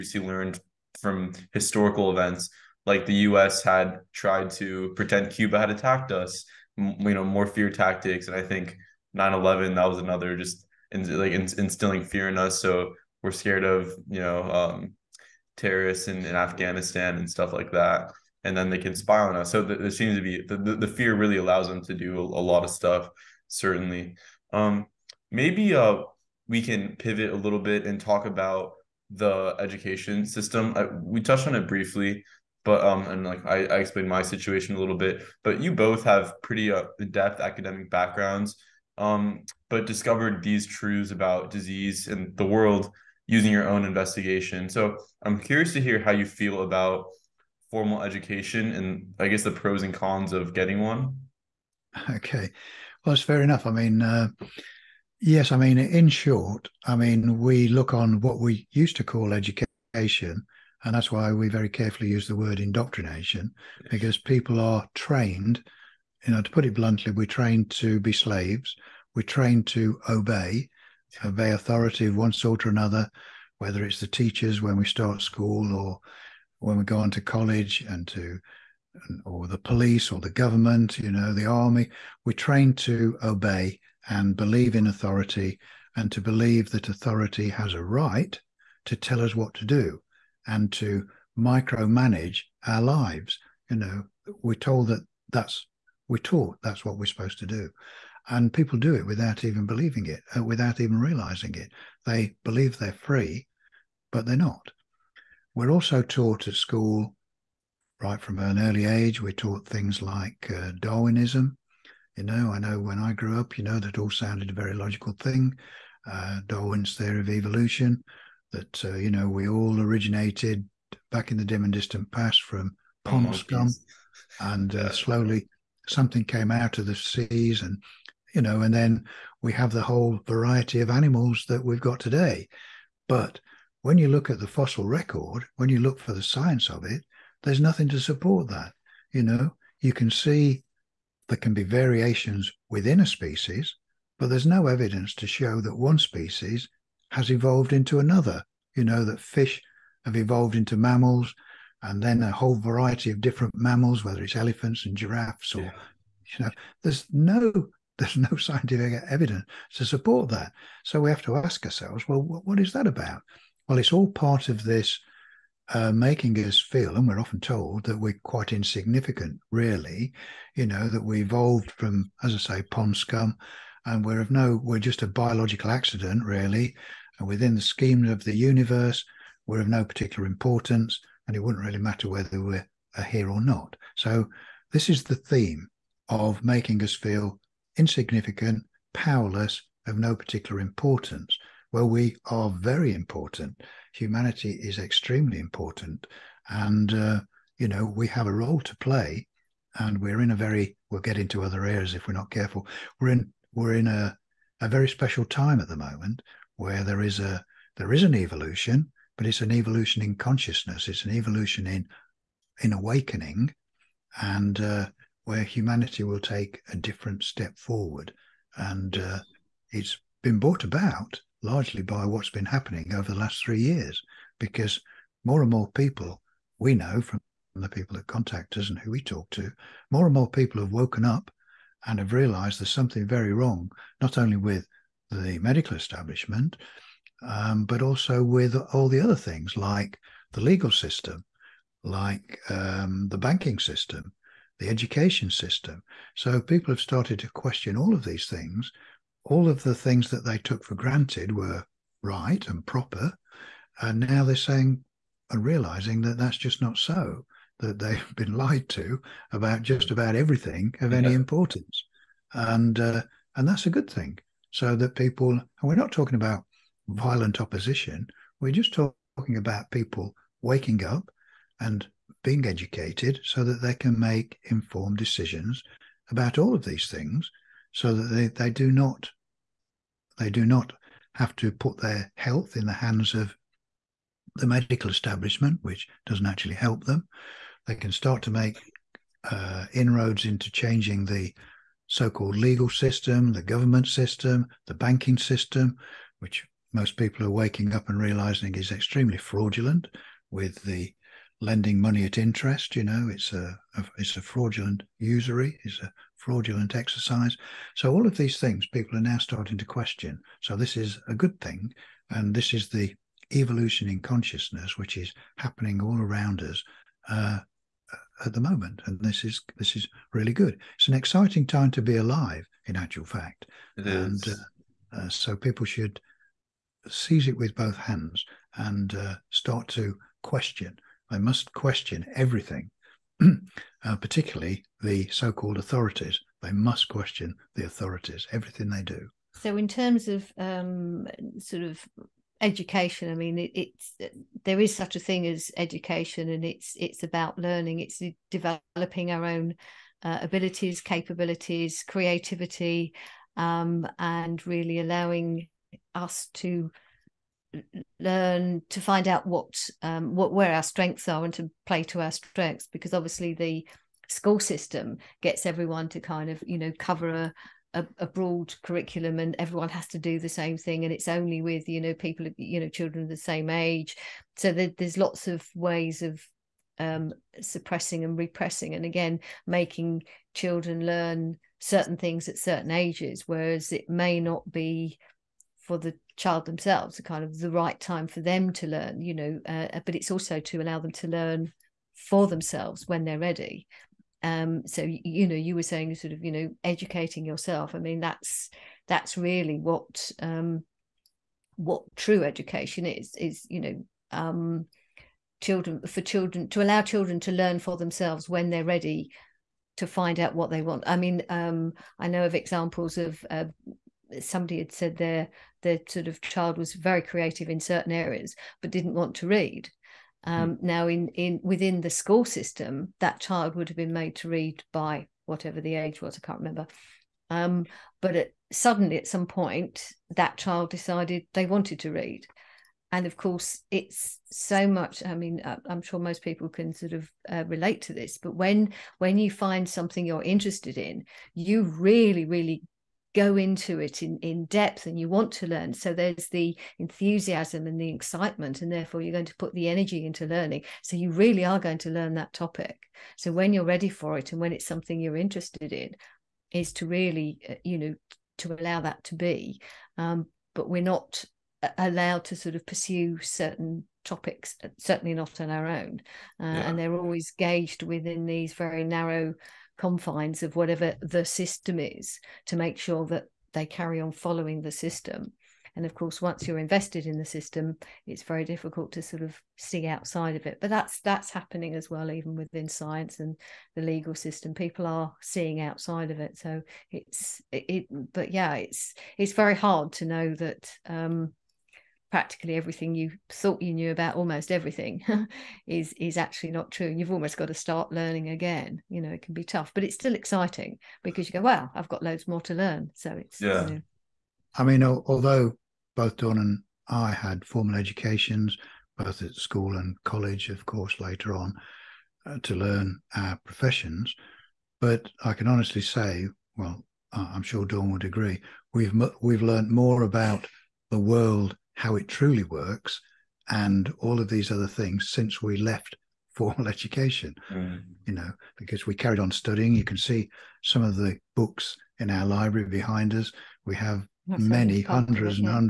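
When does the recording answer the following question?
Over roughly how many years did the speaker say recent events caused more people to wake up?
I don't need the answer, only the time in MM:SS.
03:43.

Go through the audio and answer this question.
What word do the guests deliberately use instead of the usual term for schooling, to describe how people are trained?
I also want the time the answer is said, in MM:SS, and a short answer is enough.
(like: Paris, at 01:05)
indoctrination, at 01:02.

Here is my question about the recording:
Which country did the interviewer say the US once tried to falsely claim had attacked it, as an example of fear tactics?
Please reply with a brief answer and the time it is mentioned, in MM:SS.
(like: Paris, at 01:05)
Cuba, at 00:05.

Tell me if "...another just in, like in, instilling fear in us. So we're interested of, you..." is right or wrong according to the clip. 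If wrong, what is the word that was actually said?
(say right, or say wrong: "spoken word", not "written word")
wrong: "scared", not "interested".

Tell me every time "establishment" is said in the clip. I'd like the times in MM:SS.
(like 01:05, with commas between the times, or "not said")
03:55, 04:44.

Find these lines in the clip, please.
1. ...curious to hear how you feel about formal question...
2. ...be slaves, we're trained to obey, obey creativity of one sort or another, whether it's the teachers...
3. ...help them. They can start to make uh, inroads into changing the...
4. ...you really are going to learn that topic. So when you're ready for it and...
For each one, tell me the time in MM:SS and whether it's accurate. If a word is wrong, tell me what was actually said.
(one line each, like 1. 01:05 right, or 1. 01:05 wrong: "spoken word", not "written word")
1. 00:45 wrong: "education", not "question"
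2. 01:07 wrong: "authority", not "creativity"
3. 04:46 right
4. 07:30 right.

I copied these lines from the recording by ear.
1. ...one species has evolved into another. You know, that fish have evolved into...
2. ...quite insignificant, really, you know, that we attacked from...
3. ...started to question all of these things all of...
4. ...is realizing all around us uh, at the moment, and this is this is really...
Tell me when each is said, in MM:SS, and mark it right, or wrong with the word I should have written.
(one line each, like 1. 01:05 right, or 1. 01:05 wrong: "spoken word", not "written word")
1. 02:25 right
2. 02:48 wrong: "evolved", not "attacked"
3. 04:06 right
4. 05:14 wrong: "happening", not "realizing".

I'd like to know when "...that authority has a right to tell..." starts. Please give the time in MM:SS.
01:26.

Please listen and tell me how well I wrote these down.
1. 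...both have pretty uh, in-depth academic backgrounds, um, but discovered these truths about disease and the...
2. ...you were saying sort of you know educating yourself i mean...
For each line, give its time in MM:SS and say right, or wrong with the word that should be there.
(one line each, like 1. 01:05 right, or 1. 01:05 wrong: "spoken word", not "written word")
1. 00:35 right
2. 06:35 right.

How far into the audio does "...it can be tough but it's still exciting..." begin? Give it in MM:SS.
08:19.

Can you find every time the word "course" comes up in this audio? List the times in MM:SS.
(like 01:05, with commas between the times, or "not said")
07:13, 07:55, 08:30.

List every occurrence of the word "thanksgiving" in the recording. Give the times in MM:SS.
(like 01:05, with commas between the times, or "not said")
not said.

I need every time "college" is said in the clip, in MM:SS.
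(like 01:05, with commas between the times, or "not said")
01:17, 08:30.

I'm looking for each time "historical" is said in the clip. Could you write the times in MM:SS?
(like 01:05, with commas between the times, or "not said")
00:01.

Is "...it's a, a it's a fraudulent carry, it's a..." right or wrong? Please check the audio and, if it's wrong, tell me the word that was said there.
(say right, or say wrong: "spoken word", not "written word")
wrong: "usury", not "carry".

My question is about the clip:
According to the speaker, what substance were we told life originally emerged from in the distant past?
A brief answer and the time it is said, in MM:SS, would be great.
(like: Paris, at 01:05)
pond scum, at 02:03.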